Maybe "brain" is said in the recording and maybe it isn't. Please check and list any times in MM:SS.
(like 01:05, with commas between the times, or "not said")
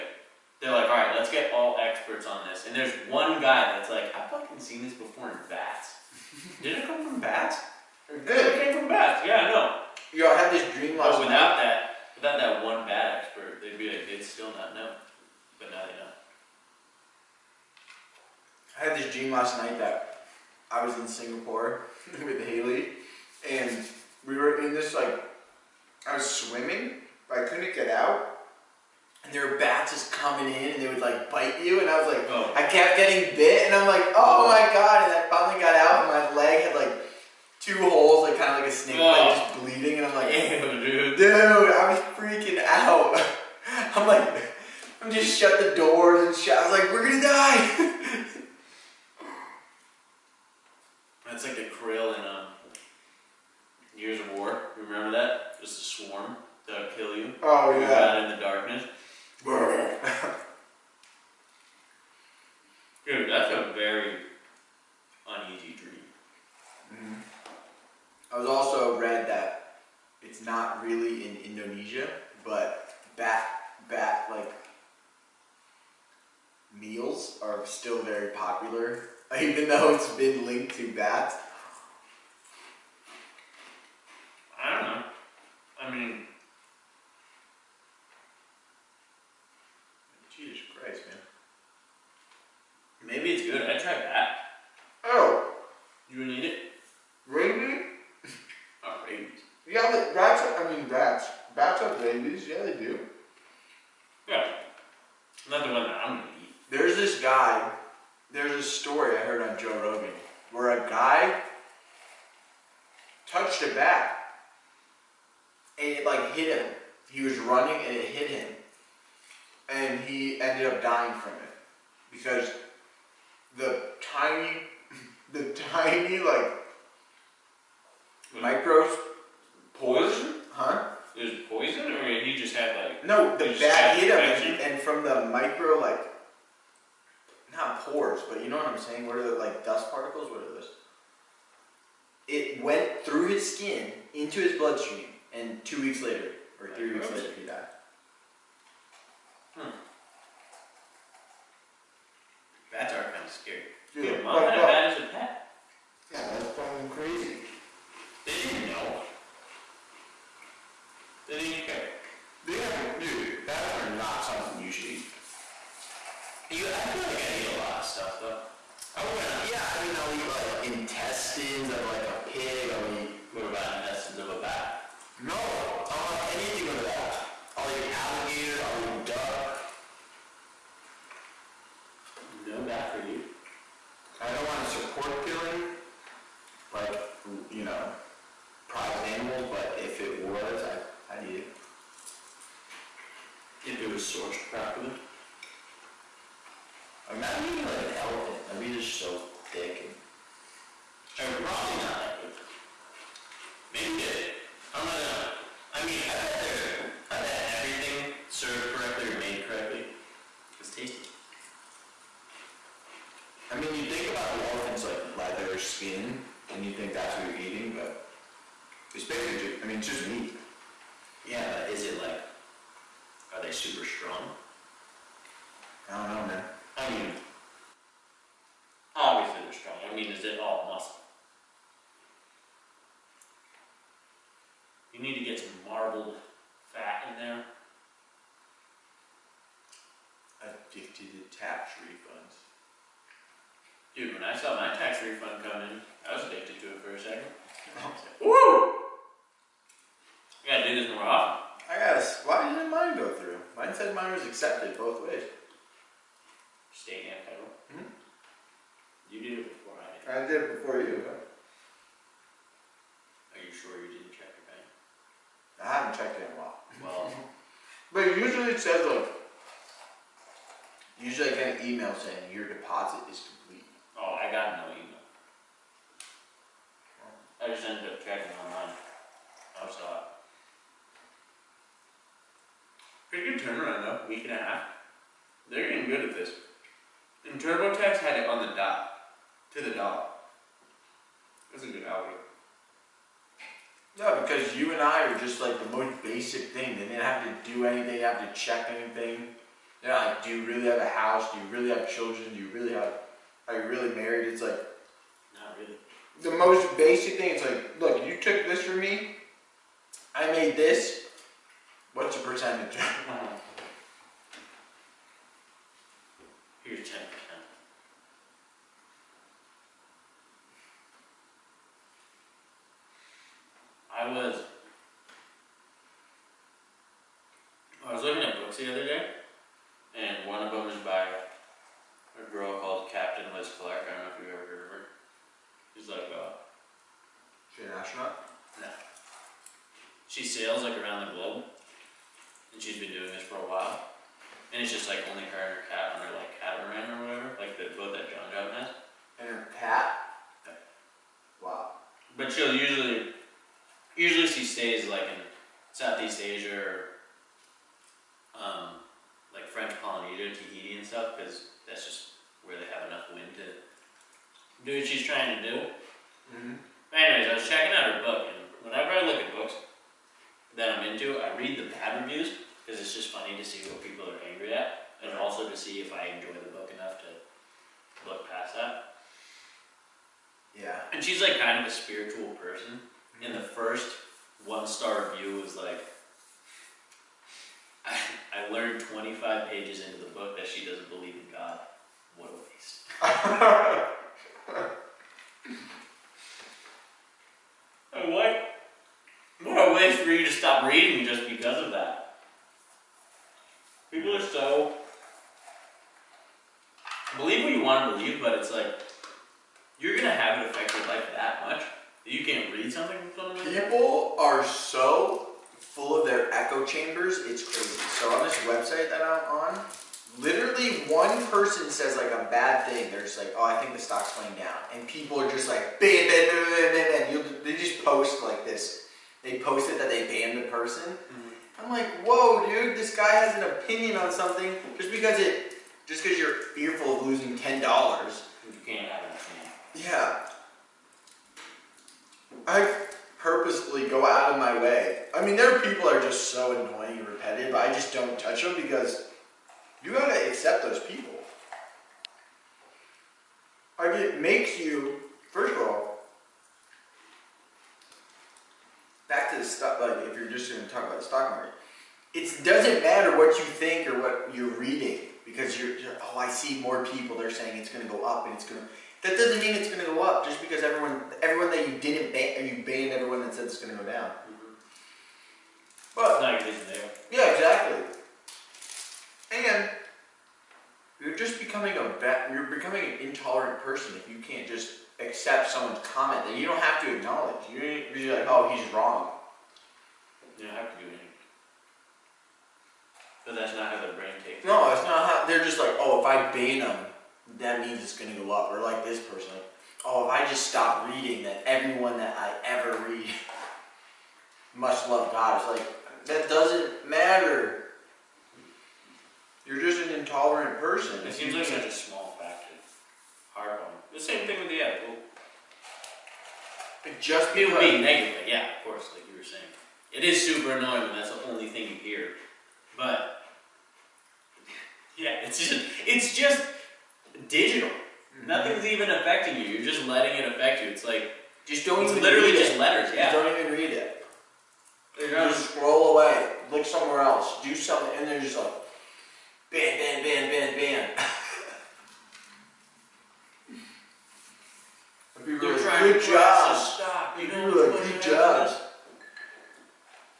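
08:13.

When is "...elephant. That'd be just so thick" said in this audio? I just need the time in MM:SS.
03:17.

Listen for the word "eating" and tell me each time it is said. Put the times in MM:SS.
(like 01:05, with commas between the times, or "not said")
03:17, 03:37.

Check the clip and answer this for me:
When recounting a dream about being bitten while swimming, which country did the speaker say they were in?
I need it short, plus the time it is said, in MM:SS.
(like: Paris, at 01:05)
Singapore, at 00:21.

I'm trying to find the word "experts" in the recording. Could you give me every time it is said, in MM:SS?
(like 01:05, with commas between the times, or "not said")
00:01, 00:13.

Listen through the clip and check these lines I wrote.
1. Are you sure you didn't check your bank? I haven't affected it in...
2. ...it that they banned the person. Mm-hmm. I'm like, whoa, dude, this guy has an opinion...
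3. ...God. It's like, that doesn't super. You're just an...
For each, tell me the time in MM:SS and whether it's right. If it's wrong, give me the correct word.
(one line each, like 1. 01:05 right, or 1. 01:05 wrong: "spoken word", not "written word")
1. 04:21 wrong: "checked", not "affected"
2. 07:09 right
3. 08:25 wrong: "matter", not "super".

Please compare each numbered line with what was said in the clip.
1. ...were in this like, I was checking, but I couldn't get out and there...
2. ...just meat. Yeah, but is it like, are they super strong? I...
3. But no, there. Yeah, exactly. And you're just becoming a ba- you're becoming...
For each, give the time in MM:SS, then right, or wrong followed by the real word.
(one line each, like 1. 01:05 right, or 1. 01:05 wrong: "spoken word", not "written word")
1. 00:24 wrong: "swimming", not "checking"
2. 03:39 right
3. 07:55 right.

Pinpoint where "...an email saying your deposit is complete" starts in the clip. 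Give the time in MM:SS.
04:31.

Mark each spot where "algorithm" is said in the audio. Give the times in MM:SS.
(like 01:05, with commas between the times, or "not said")
04:51.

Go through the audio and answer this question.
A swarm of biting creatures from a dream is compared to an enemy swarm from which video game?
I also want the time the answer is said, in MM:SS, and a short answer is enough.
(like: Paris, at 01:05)
Gears of War, at 00:53.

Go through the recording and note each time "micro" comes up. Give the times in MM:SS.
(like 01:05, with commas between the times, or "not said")
02:08, 02:15.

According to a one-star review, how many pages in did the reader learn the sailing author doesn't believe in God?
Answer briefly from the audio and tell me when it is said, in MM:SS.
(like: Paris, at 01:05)
25, at 06:28.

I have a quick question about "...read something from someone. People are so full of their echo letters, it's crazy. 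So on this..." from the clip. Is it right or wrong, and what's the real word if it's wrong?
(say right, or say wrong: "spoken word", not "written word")
wrong: "chambers", not "letters".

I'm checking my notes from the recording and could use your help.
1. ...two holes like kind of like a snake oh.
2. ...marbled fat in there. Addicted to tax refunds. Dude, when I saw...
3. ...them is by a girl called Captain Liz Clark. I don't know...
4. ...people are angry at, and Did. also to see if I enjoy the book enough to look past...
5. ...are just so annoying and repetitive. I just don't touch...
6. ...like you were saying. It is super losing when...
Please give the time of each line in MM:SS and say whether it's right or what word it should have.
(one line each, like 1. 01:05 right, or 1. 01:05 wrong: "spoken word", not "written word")
1. 00:37 right
2. 03:55 right
3. 05:30 right
4. 06:13 wrong: "Right", not "Did"
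5. 07:25 right
6. 08:38 wrong: "annoying", not "losing".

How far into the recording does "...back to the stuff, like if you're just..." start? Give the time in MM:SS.
07:39.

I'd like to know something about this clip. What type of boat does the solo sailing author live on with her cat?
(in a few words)
Catamaran.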